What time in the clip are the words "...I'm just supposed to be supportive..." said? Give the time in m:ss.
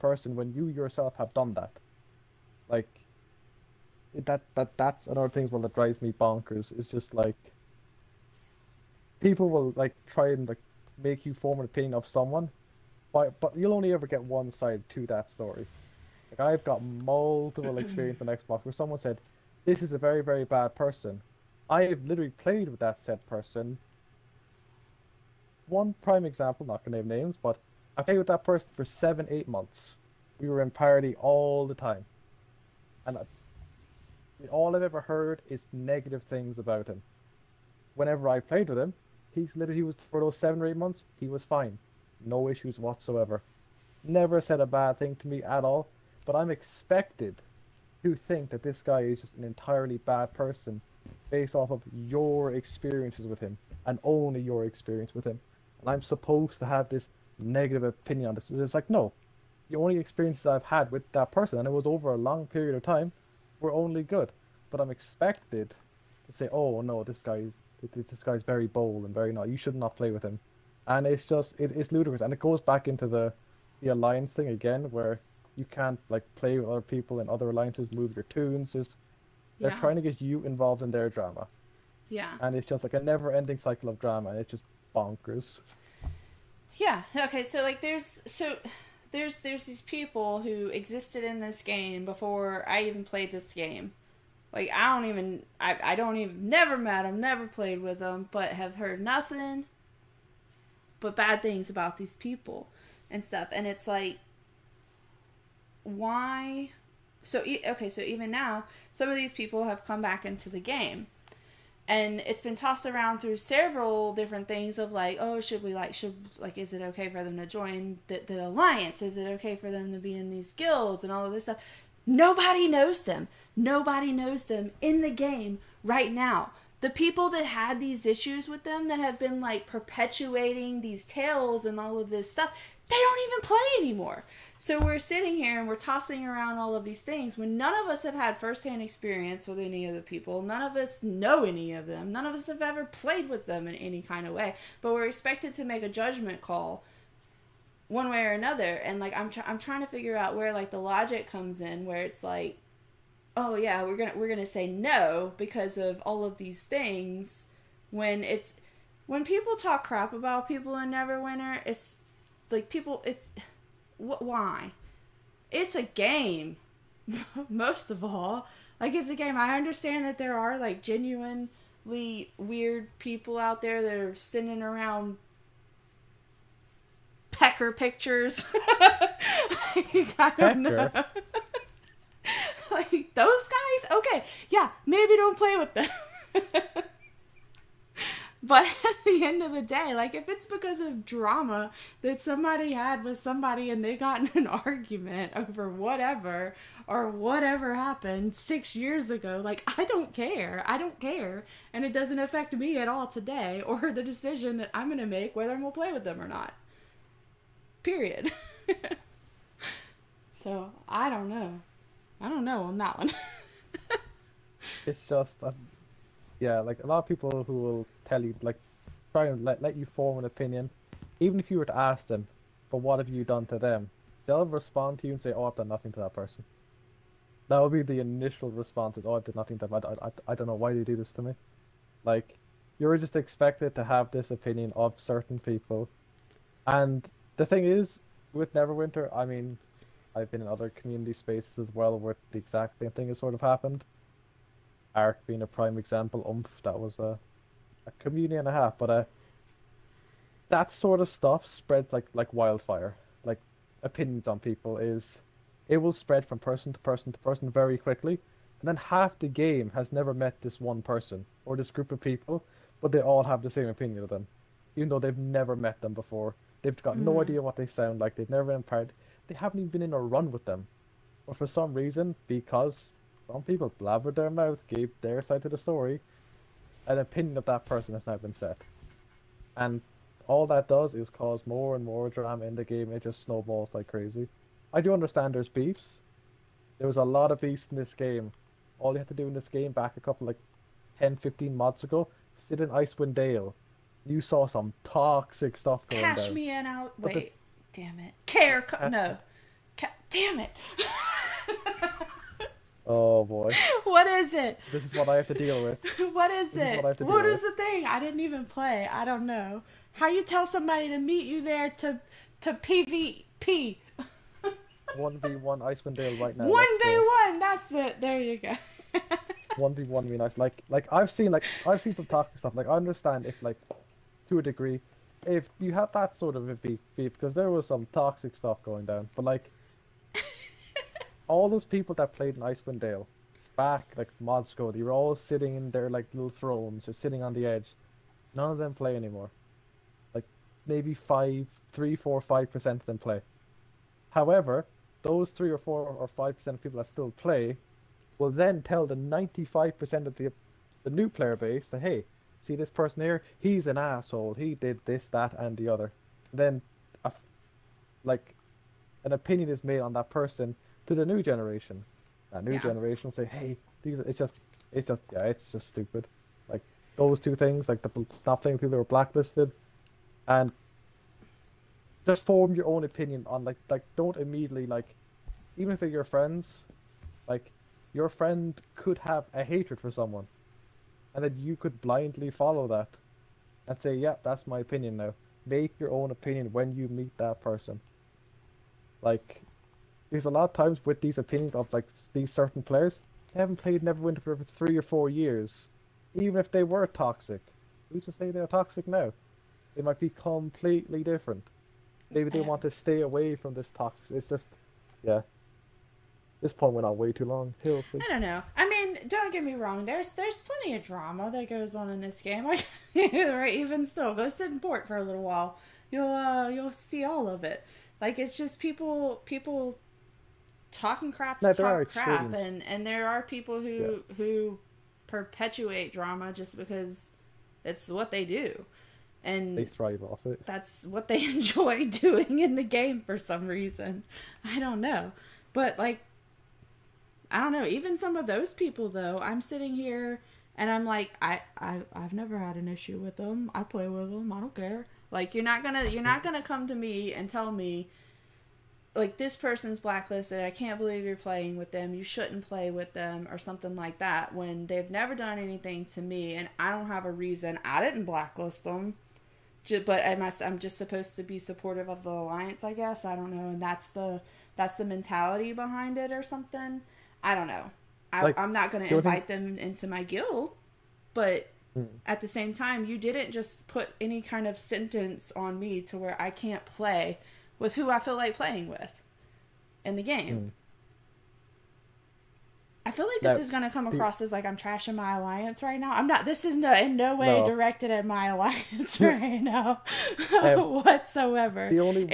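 7:40.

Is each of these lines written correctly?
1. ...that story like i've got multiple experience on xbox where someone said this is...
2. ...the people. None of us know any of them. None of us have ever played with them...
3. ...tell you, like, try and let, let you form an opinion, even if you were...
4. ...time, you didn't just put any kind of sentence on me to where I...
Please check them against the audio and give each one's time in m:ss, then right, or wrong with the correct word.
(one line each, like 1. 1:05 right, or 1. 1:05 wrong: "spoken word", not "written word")
1. 0:15 right
2. 2:19 right
3. 3:38 right
4. 7:52 right.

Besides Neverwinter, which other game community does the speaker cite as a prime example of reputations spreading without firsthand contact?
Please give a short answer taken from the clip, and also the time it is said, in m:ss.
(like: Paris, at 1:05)
Ark, at 4:04.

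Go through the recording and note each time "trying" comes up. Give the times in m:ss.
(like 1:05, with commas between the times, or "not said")
1:19, 2:29.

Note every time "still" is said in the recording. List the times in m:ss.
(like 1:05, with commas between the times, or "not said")
5:46, 6:53.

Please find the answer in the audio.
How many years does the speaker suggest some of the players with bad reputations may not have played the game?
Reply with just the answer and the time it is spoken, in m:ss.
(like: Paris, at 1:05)
3 or 4 years, at 6:34.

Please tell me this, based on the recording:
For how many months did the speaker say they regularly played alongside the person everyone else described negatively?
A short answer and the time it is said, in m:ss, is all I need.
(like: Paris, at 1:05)
7 or 8 months, at 0:28.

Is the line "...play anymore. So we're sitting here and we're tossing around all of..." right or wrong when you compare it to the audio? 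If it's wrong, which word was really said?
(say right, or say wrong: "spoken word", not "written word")
right.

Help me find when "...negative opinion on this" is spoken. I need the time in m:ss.
0:57.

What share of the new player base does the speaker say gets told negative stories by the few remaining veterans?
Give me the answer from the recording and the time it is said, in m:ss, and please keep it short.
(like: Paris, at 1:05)
95 percent, at 5:48.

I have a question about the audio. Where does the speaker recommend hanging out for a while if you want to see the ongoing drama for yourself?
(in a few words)
port.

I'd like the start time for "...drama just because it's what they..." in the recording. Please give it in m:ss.
7:05.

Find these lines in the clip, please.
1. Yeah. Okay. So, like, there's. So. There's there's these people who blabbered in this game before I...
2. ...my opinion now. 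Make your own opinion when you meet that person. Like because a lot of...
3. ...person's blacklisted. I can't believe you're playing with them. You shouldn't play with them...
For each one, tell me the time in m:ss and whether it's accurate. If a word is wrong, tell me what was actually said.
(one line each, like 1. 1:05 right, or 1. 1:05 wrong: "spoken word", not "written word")
1. 1:26 wrong: "existed", not "blabbered"
2. 6:24 right
3. 7:29 right.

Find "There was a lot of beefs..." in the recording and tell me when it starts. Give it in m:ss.
4:46.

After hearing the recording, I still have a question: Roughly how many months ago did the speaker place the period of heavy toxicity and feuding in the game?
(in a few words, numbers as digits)
10 to 15 months.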